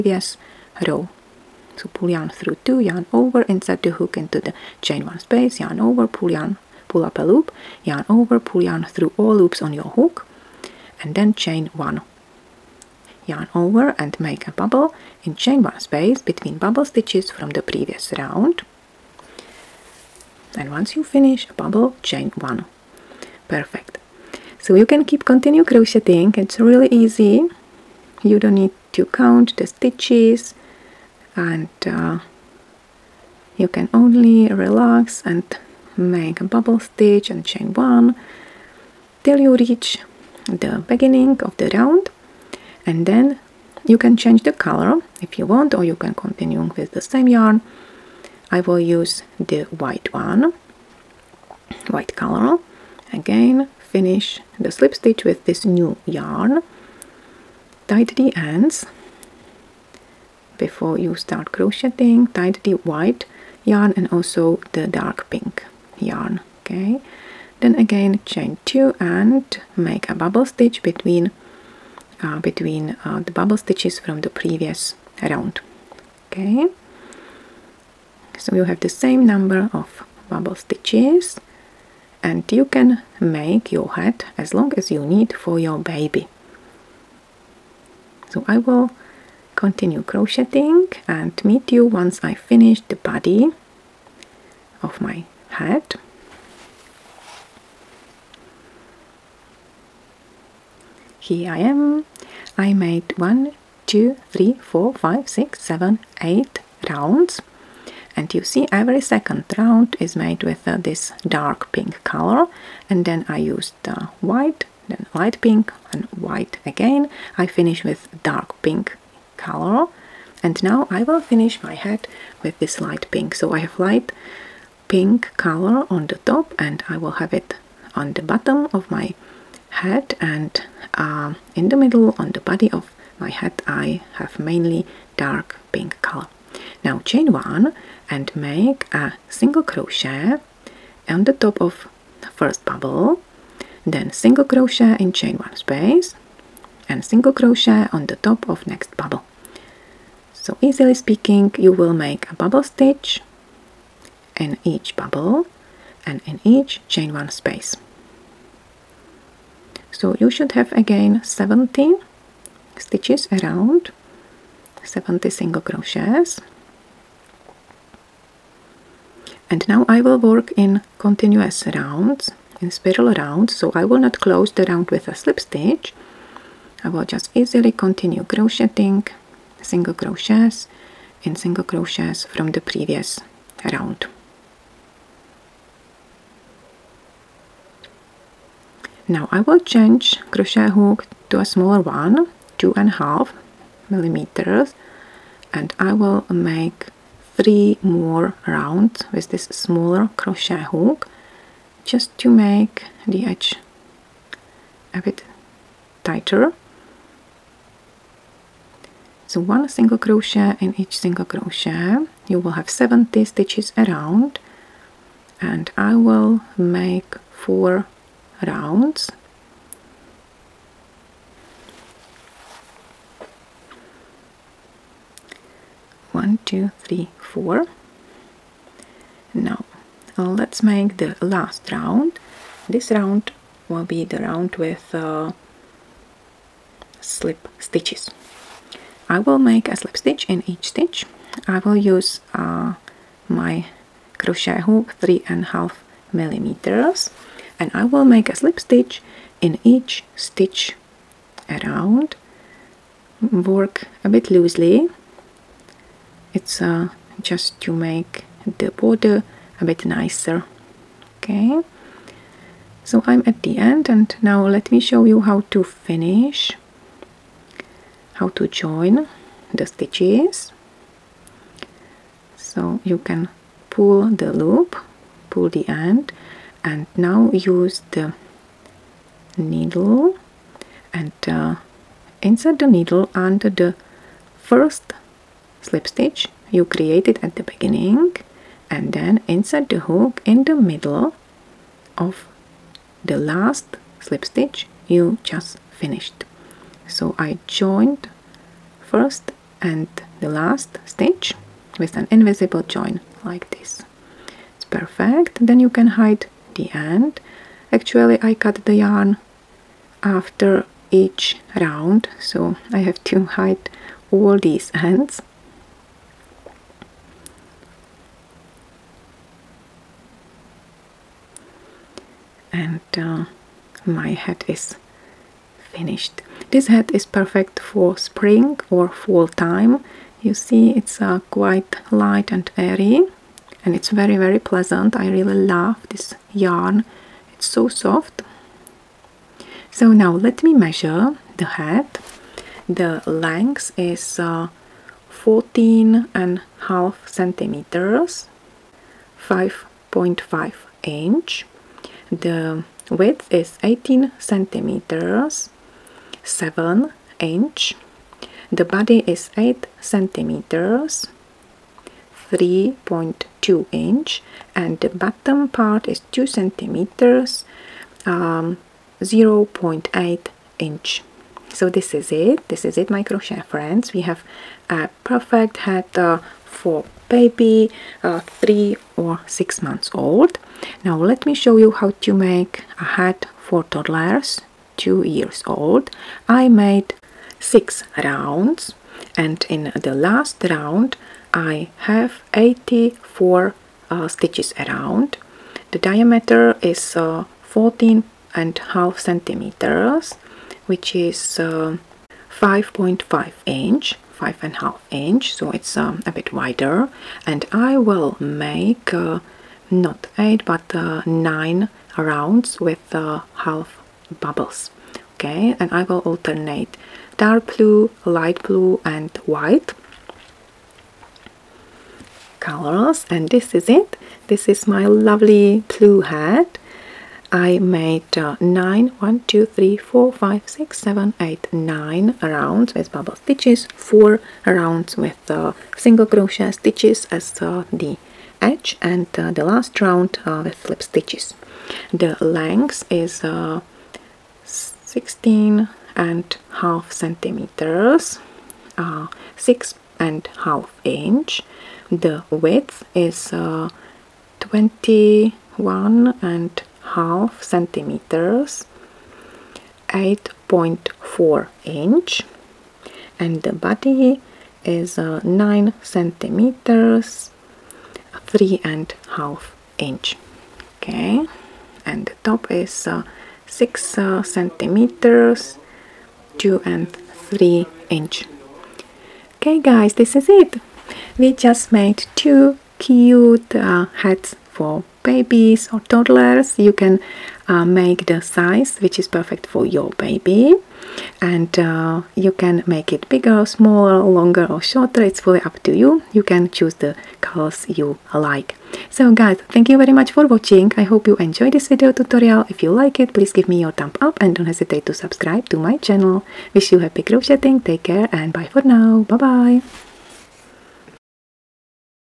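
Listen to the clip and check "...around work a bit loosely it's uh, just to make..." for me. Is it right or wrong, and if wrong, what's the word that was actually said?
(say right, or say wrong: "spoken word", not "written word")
right.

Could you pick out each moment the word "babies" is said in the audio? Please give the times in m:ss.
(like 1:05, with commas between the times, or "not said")
8:05.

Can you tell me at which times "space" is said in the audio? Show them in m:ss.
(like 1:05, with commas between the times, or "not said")
0:05, 0:15, 2:25, 2:37.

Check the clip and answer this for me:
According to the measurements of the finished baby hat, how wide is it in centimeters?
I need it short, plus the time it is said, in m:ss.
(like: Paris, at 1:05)
18 centimeters, at 5:53.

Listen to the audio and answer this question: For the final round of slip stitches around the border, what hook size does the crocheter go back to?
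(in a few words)
3.5 millimeters.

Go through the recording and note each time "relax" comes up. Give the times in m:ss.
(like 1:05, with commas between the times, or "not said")
0:34.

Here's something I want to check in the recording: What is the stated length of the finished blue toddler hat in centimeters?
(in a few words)
16.5 centimeters.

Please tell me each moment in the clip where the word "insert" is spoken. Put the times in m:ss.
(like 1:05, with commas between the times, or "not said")
0:03, 4:42, 4:49.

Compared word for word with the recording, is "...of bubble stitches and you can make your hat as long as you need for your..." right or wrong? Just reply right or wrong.
right.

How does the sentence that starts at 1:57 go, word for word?
I finish with dark pink color and now I will finish my head with this light pink.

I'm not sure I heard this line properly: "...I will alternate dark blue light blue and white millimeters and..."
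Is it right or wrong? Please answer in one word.
wrong.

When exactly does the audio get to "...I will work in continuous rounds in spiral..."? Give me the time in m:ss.
2:49.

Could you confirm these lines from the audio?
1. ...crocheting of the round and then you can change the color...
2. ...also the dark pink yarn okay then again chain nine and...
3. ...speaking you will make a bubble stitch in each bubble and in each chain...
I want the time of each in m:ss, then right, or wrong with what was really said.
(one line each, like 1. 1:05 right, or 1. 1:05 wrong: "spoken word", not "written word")
1. 0:40 wrong: "beginning", not "crocheting"
2. 1:04 wrong: "two", not "nine"
3. 2:30 right.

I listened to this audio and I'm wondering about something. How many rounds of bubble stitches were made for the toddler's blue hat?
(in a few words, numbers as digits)
9.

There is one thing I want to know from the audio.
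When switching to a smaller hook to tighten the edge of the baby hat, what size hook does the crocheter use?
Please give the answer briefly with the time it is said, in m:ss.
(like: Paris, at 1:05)
2.5 millimeters, at 3:12.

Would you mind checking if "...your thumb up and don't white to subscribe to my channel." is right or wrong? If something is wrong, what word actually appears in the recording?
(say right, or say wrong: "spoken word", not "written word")
wrong: "hesitate", not "white".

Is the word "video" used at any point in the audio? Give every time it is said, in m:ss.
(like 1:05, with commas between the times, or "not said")
8:21.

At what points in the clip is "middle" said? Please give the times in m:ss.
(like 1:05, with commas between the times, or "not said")
2:11, 4:50.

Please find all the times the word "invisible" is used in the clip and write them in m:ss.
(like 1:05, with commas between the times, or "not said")
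5:02.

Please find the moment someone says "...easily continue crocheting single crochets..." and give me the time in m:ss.
2:57.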